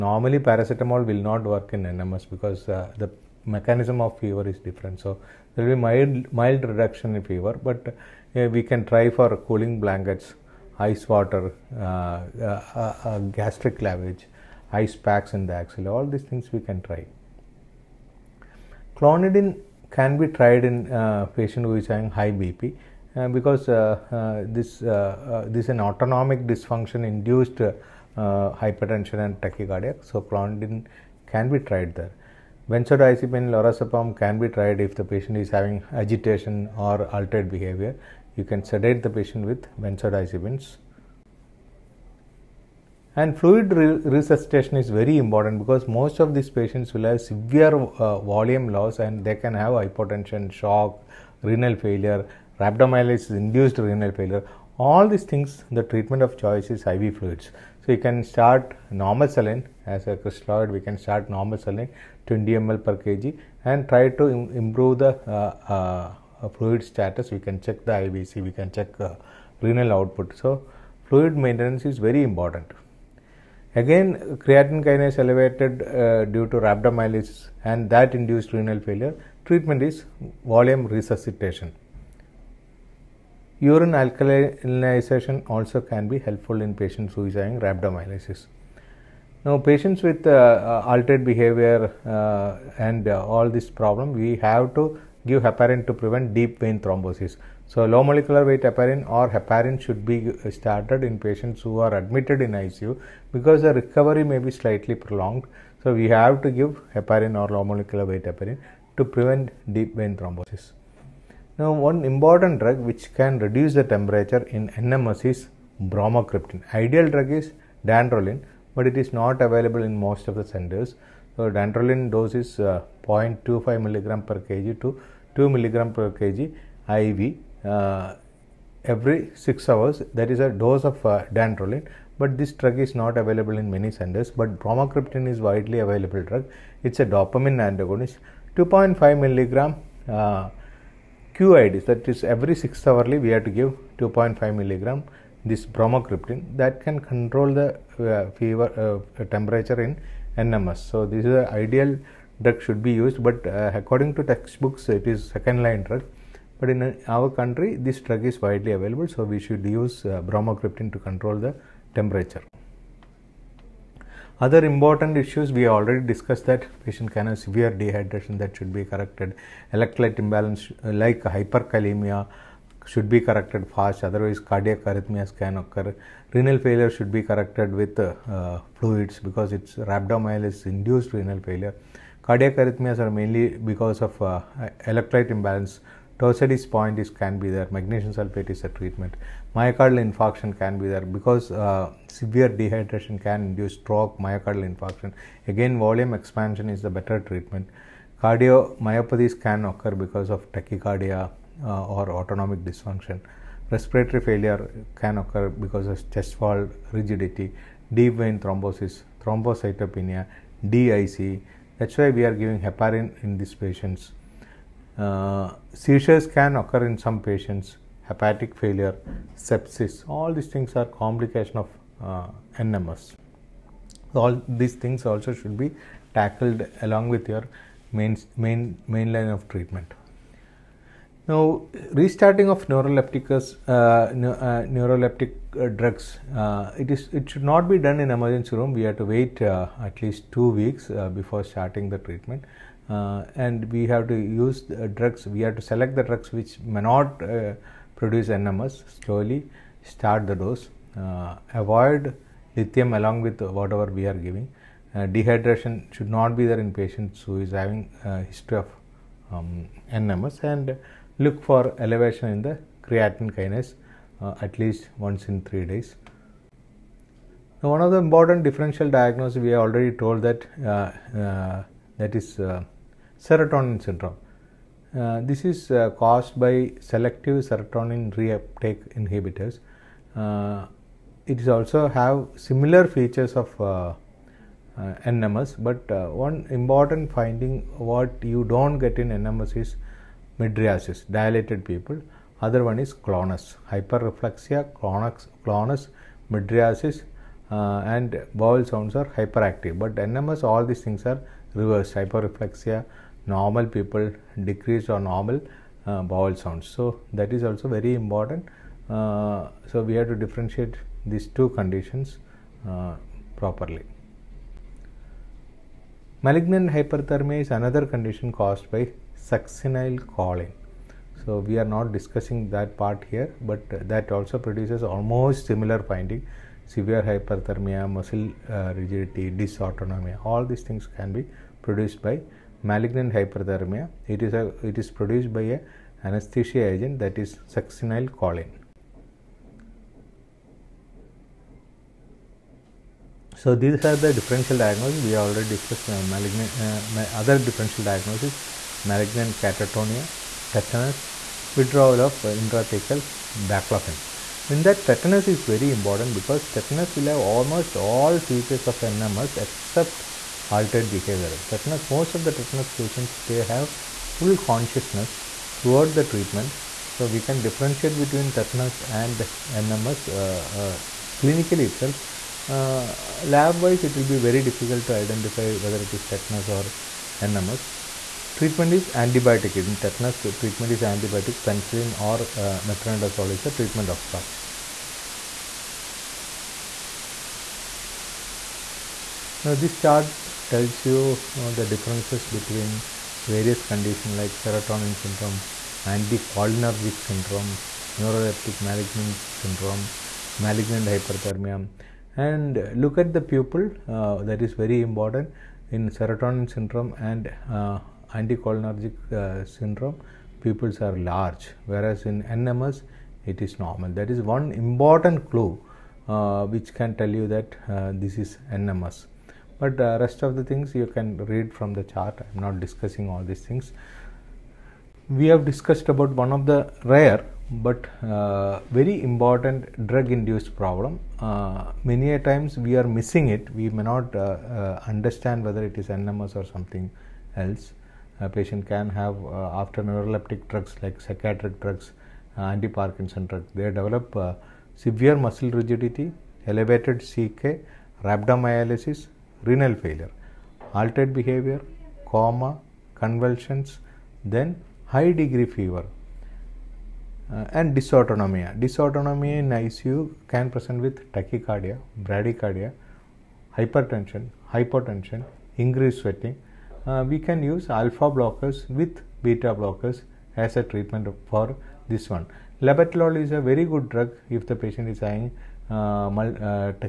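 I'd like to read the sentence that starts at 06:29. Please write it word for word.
Now, this chart tells you uh, the differences between various conditions like serotonin syndrome, anticholinergic syndrome, neuroleptic malignant syndrome, malignant hyperthermia.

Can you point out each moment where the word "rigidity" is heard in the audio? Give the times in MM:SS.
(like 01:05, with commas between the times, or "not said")
03:26, 05:28, 07:25.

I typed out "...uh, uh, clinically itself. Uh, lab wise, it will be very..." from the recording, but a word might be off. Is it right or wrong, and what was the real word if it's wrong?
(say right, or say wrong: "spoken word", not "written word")
right.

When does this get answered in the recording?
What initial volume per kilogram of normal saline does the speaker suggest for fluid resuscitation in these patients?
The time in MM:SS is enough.
01:02.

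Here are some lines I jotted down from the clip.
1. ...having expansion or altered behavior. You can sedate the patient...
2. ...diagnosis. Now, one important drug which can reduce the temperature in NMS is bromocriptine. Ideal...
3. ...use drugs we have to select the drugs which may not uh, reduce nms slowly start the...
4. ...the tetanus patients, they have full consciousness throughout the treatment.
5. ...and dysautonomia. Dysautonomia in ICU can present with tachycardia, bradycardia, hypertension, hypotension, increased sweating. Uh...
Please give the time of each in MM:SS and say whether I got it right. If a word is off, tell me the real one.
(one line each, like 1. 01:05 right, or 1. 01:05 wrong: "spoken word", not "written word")
1. 00:35 wrong: "agitation", not "expansion"
2. 01:50 wrong: "thrombosis", not "diagnosis"
3. 04:04 wrong: "produce", not "reduce"
4. 06:02 right
5. 07:37 right.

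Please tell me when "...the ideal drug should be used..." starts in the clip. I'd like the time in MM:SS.
02:31.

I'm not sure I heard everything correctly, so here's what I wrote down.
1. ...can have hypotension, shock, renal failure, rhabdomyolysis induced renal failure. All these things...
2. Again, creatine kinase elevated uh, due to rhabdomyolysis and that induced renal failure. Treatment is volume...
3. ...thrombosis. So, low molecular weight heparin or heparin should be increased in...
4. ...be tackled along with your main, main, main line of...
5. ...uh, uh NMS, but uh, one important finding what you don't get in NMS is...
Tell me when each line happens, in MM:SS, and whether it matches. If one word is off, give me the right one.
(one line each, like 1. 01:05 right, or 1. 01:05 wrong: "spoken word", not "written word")
1. 00:49 right
2. 01:13 right
3. 01:36 wrong: "started", not "increased"
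4. 03:45 right
5. 04:43 right.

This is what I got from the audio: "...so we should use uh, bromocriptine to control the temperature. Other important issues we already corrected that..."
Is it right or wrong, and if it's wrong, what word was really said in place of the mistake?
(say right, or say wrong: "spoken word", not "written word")
wrong: "discussed", not "corrected".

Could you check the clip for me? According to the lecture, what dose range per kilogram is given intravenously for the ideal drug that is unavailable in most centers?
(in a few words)
0.25 to 2 mg per kg.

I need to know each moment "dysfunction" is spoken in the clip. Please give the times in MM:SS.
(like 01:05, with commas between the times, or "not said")
00:26, 03:22.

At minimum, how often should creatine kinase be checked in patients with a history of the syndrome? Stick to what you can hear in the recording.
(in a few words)
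Once in 3 days.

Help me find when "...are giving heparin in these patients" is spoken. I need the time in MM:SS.
03:32.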